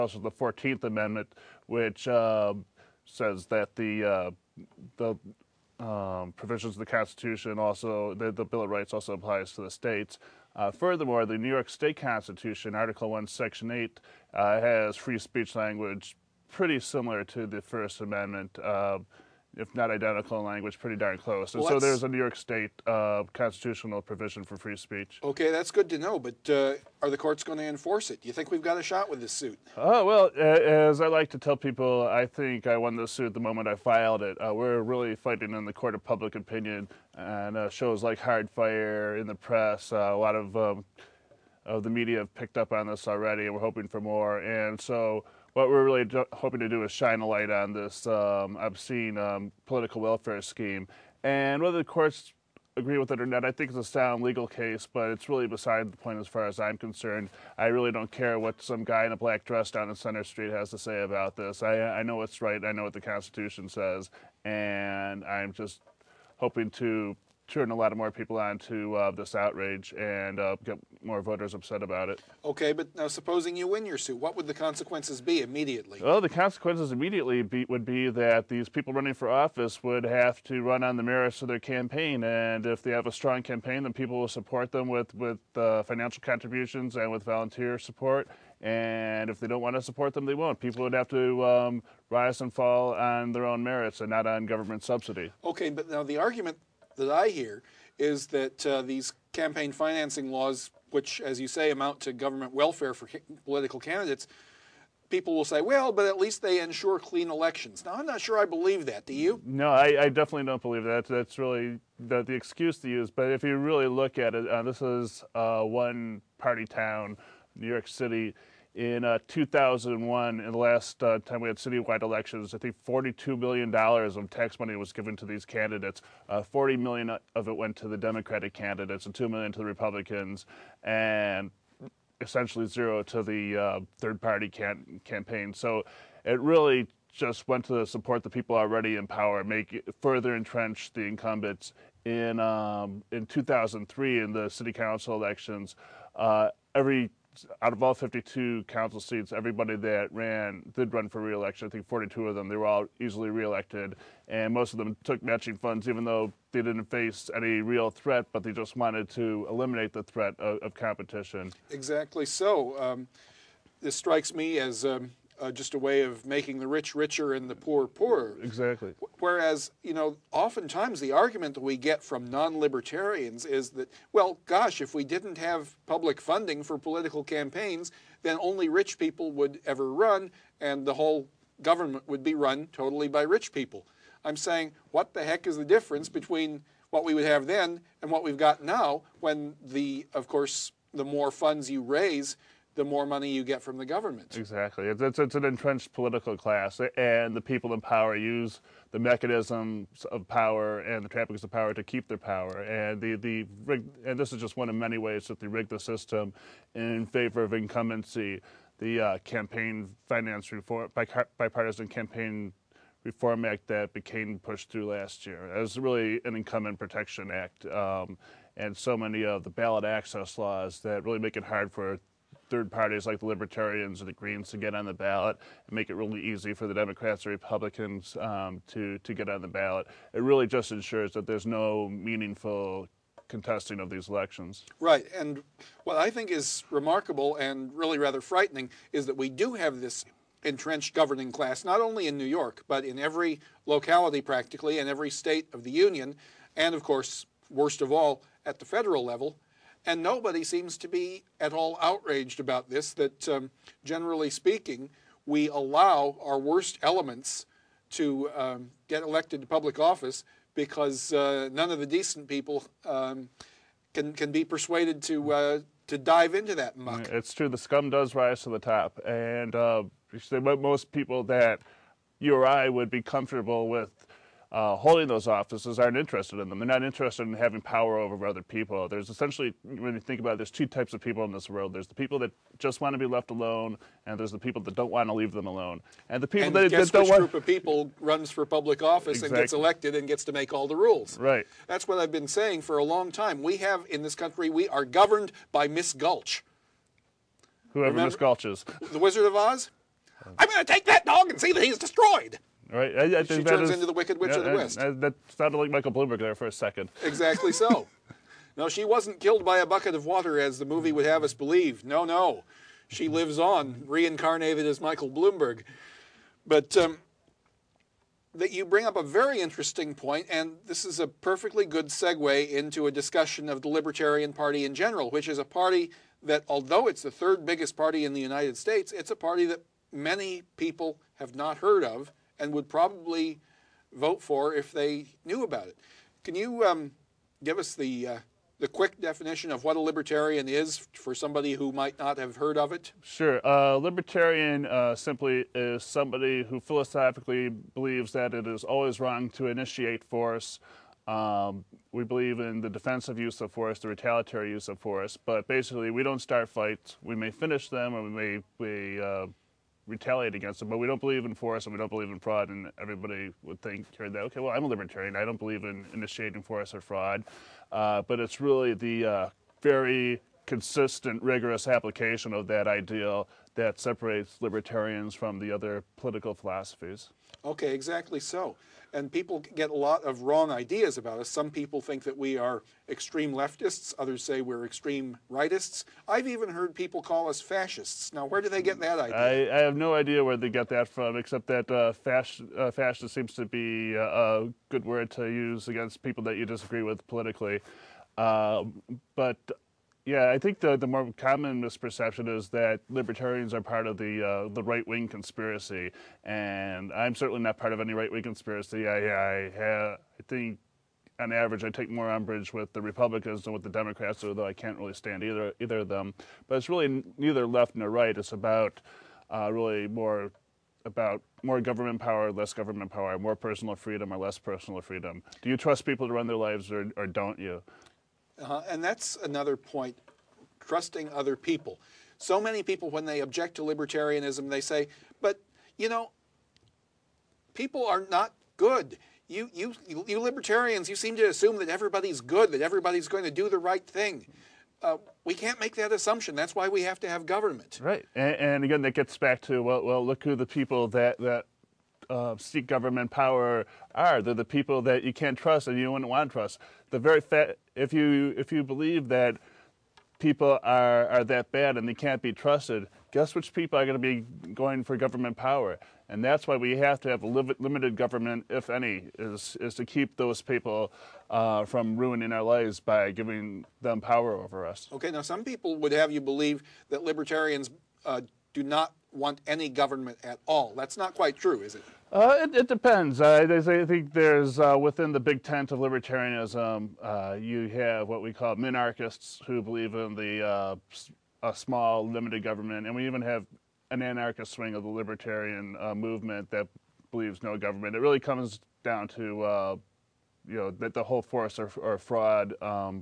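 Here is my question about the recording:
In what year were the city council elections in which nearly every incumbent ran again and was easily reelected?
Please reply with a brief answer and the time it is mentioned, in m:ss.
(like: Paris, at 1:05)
2003, at 2:23.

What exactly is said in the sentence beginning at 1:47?
Now, I'm not sure I believe that.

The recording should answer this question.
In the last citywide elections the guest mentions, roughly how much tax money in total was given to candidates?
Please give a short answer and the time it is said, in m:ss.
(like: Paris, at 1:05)
$42 million, at 2:02.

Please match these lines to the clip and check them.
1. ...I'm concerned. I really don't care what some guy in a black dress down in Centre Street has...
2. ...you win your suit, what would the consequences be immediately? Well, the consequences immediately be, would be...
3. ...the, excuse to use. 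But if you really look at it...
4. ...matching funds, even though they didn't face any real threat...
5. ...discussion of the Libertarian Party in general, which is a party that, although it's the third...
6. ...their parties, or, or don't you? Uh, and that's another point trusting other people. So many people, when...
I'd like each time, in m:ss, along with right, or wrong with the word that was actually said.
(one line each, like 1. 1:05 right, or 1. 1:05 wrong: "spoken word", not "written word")
1. 0:56 right
2. 1:13 right
3. 1:52 right
4. 2:35 right
5. 5:22 right
6. 7:06 wrong: "lives", not "parties".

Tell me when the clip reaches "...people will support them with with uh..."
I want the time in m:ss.
1:23.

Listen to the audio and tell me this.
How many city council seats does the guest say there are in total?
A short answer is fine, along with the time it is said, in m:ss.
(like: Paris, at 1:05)
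52, at 2:27.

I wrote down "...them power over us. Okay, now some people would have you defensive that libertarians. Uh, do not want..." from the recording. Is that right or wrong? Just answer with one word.
wrong.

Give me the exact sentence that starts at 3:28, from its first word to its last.
The uh, campaign finance reform, bipartisan campaign reform act that became pushed through last year.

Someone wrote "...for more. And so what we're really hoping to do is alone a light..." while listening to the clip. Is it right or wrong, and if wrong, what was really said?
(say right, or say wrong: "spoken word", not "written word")
wrong: "shine", not "alone".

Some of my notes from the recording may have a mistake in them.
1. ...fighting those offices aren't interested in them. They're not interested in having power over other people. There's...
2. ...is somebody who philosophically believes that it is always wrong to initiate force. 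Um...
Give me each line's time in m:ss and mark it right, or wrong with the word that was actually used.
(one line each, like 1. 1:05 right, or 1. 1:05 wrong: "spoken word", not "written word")
1. 4:34 wrong: "holding", not "fighting"
2. 5:45 right.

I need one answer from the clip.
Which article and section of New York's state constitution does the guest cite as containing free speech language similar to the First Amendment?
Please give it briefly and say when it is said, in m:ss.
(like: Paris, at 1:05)
Article 1, Section 8, at 0:12.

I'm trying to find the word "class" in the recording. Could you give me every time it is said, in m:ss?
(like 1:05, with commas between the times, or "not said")
3:16, 4:01.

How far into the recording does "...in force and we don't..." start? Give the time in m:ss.
6:01.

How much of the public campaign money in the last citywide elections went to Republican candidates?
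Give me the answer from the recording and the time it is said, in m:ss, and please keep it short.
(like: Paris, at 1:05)
$2 million, at 2:09.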